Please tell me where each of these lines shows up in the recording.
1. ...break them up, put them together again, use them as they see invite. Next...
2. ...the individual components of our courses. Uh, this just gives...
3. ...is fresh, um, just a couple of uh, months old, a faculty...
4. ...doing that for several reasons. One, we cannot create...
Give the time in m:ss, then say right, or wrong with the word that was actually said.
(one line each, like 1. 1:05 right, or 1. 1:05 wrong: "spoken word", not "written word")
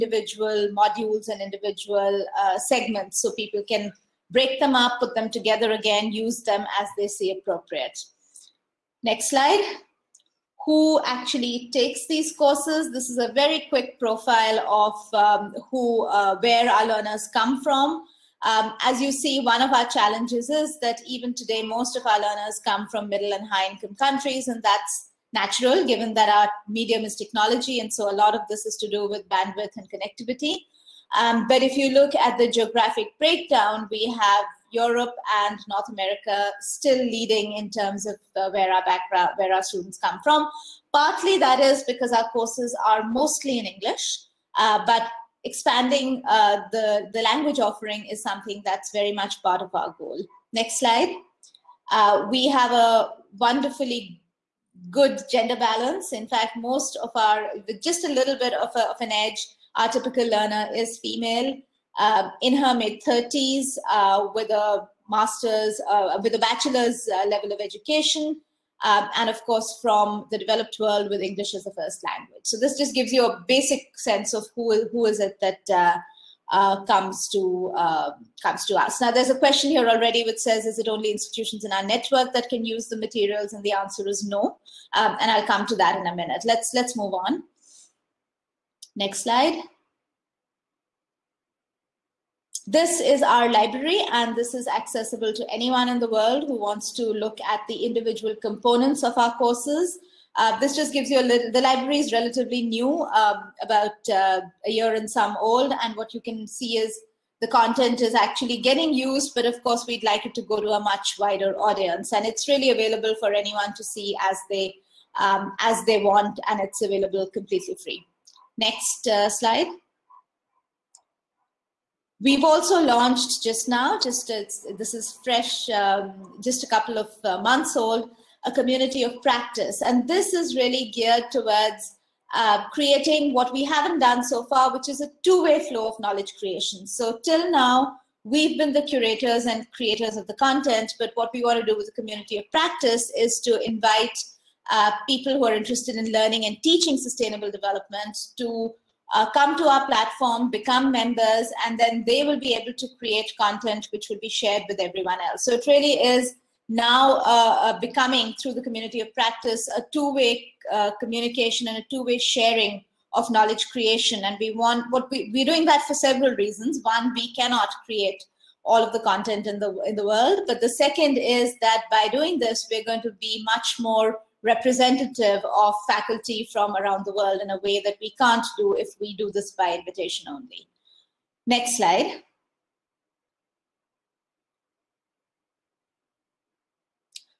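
1. 0:04 wrong: "appropriate", not "invite"
2. 1:37 right
3. 2:04 wrong: "community", not "faculty"
4. 2:45 right.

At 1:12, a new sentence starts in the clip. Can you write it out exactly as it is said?
So this just gives you a basic sense of who who is it that.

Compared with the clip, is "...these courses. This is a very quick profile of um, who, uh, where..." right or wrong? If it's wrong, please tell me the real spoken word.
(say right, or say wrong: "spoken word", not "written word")
right.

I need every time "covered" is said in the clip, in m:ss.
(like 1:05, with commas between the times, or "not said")
not said.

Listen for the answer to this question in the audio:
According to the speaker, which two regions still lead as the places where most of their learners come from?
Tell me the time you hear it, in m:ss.
0:34.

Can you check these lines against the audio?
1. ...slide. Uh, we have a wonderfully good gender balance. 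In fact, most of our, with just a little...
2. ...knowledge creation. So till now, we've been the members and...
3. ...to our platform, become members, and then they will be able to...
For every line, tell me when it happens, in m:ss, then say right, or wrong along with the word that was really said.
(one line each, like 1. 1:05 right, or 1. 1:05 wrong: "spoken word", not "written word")
1. 0:50 right
2. 2:15 wrong: "curators", not "members"
3. 2:29 right.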